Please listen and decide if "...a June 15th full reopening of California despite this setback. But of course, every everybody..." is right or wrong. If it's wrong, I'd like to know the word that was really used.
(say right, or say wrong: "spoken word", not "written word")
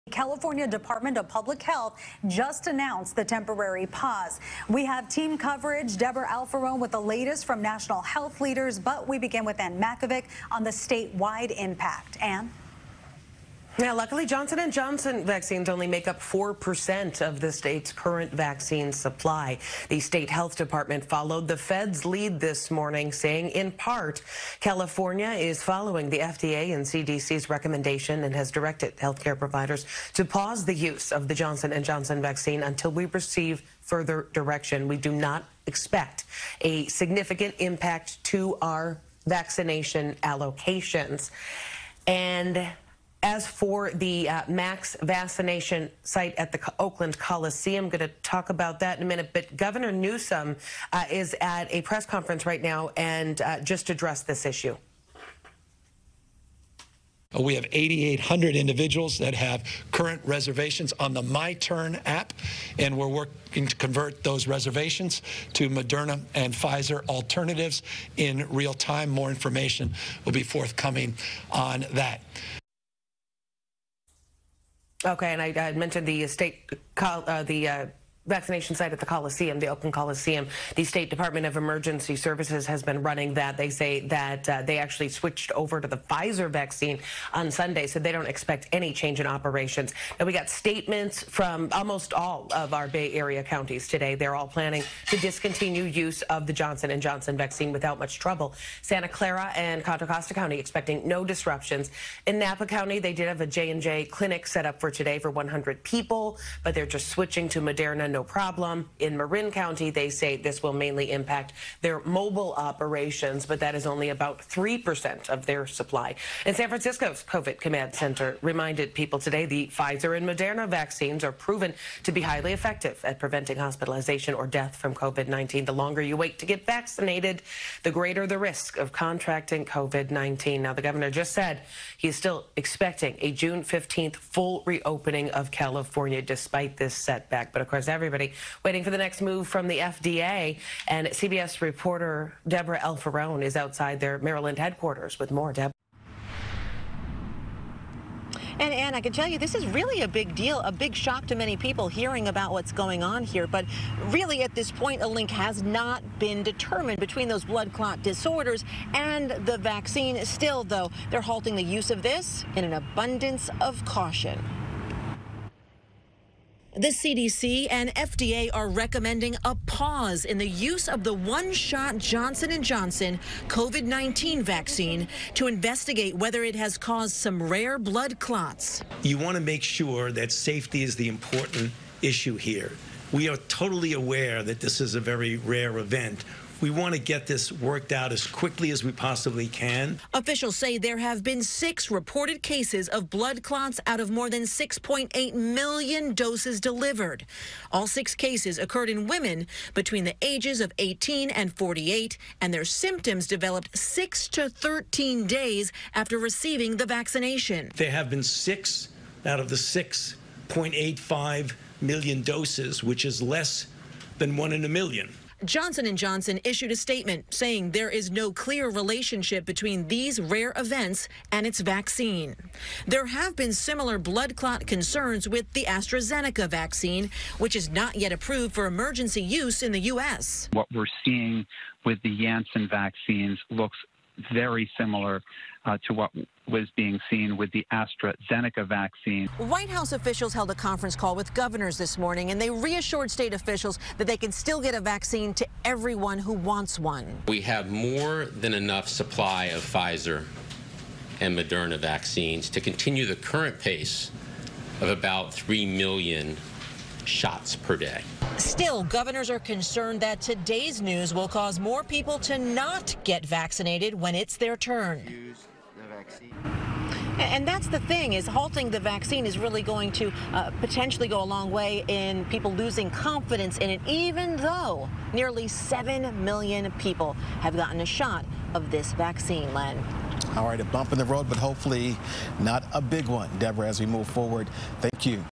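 right.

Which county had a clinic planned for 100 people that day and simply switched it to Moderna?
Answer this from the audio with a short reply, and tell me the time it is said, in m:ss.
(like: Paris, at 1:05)
Napa County, at 1:42.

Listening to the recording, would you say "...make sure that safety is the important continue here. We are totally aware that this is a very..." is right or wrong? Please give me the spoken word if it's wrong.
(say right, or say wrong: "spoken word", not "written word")
wrong: "issue", not "continue".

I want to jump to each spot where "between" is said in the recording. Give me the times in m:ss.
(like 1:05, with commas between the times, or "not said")
2:36, 3:19, 3:39.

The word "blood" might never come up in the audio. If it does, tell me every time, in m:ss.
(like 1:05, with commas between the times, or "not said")
2:37, 2:57, 3:13, 3:43.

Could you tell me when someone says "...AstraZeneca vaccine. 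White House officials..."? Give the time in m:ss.
3:57.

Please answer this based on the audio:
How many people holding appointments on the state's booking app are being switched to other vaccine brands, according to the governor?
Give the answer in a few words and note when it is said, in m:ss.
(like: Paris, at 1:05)
8,800, at 0:57.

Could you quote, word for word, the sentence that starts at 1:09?
More information will be forthcoming on that.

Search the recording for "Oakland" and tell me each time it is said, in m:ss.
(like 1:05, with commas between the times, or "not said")
0:46, 1:19.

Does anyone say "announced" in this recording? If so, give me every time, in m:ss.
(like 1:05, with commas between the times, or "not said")
0:02.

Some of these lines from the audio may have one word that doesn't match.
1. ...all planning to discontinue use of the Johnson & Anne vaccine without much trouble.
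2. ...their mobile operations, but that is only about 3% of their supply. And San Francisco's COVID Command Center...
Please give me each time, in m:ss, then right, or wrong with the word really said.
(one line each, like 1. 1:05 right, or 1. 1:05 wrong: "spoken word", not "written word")
1. 1:34 wrong: "Johnson", not "Anne"
2. 1:51 right.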